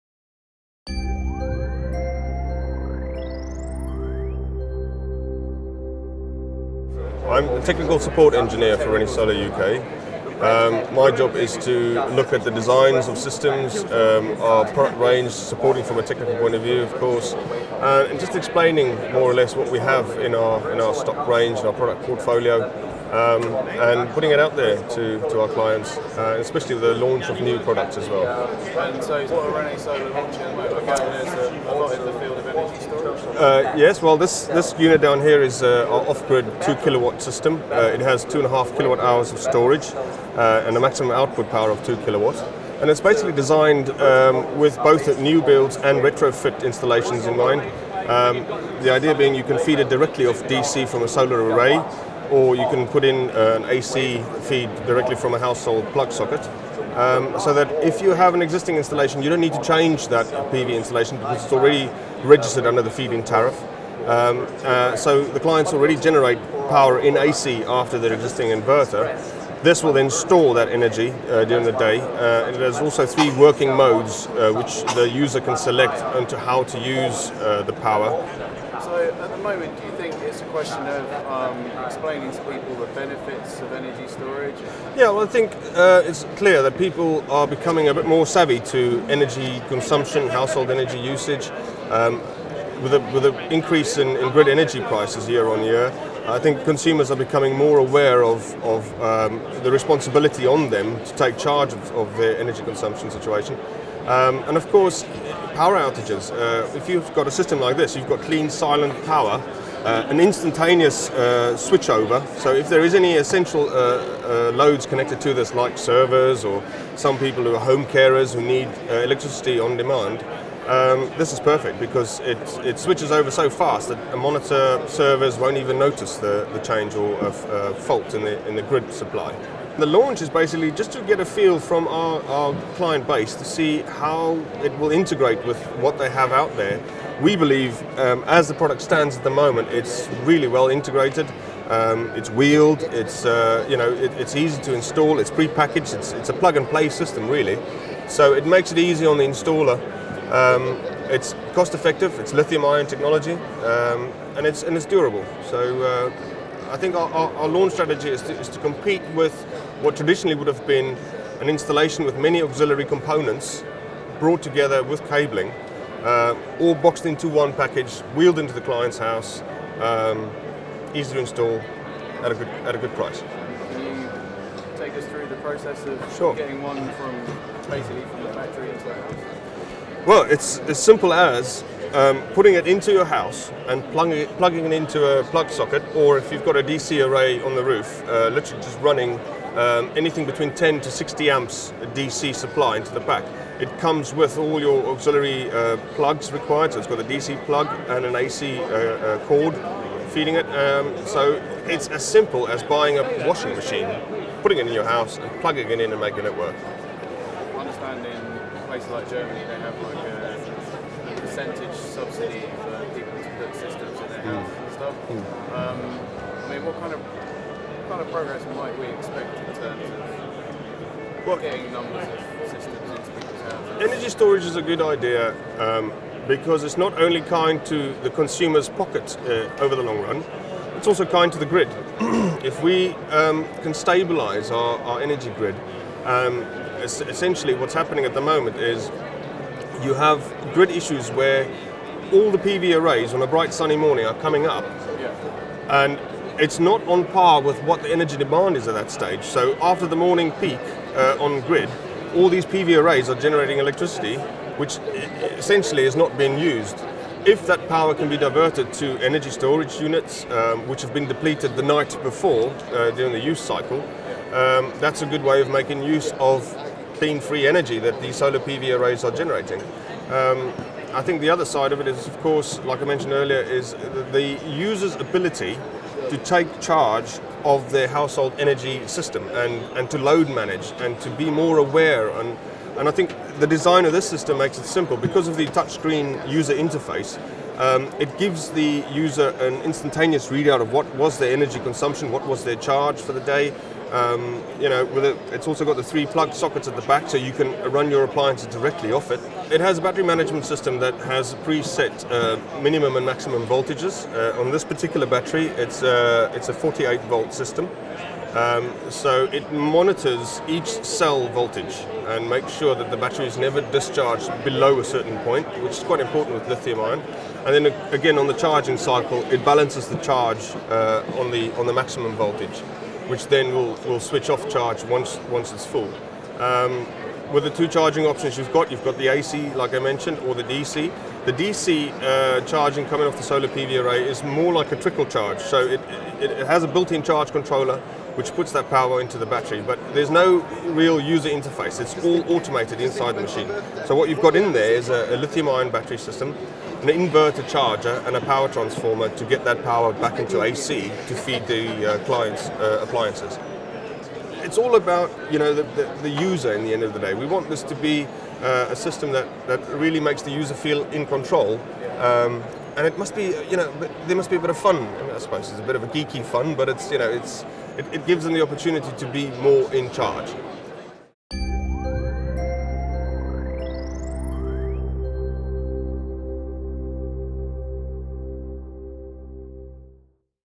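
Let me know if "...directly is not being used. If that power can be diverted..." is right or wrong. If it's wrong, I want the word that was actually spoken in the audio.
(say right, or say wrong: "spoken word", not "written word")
wrong: "essentially", not "directly".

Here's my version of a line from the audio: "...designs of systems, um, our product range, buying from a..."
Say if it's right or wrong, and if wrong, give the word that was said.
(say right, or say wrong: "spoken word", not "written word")
wrong: "supporting", not "buying".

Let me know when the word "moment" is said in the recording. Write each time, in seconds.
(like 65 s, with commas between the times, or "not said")
30 s, 79 s, 139 s, 238 s.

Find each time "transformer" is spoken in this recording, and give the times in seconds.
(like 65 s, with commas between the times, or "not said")
348 s.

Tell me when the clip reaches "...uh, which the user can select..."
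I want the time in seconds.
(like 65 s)
74 s.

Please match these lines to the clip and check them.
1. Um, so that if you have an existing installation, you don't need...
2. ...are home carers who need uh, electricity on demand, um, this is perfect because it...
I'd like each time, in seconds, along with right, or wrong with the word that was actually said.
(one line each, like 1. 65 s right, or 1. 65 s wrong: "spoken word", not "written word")
1. 56 s right
2. 117 s right.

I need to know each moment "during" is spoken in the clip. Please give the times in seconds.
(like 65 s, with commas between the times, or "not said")
71 s, 262 s.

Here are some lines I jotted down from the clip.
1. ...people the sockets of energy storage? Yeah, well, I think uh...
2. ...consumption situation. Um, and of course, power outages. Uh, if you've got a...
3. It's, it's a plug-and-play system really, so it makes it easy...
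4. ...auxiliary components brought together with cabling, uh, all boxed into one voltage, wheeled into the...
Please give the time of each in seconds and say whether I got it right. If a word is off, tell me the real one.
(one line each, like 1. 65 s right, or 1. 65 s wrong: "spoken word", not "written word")
1. 82 s wrong: "benefits", not "sockets"
2. 102 s right
3. 145 s right
4. 162 s wrong: "package", not "voltage".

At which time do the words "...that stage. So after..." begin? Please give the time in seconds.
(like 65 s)
248 s.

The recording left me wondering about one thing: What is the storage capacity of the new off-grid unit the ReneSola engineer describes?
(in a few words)
2.5 kilowatt hours.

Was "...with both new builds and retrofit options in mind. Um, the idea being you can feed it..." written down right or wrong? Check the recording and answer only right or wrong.
wrong.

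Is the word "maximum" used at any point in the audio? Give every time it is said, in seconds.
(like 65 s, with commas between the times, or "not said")
40 s, 303 s, 321 s.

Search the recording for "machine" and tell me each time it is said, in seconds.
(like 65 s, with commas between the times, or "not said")
203 s, 343 s.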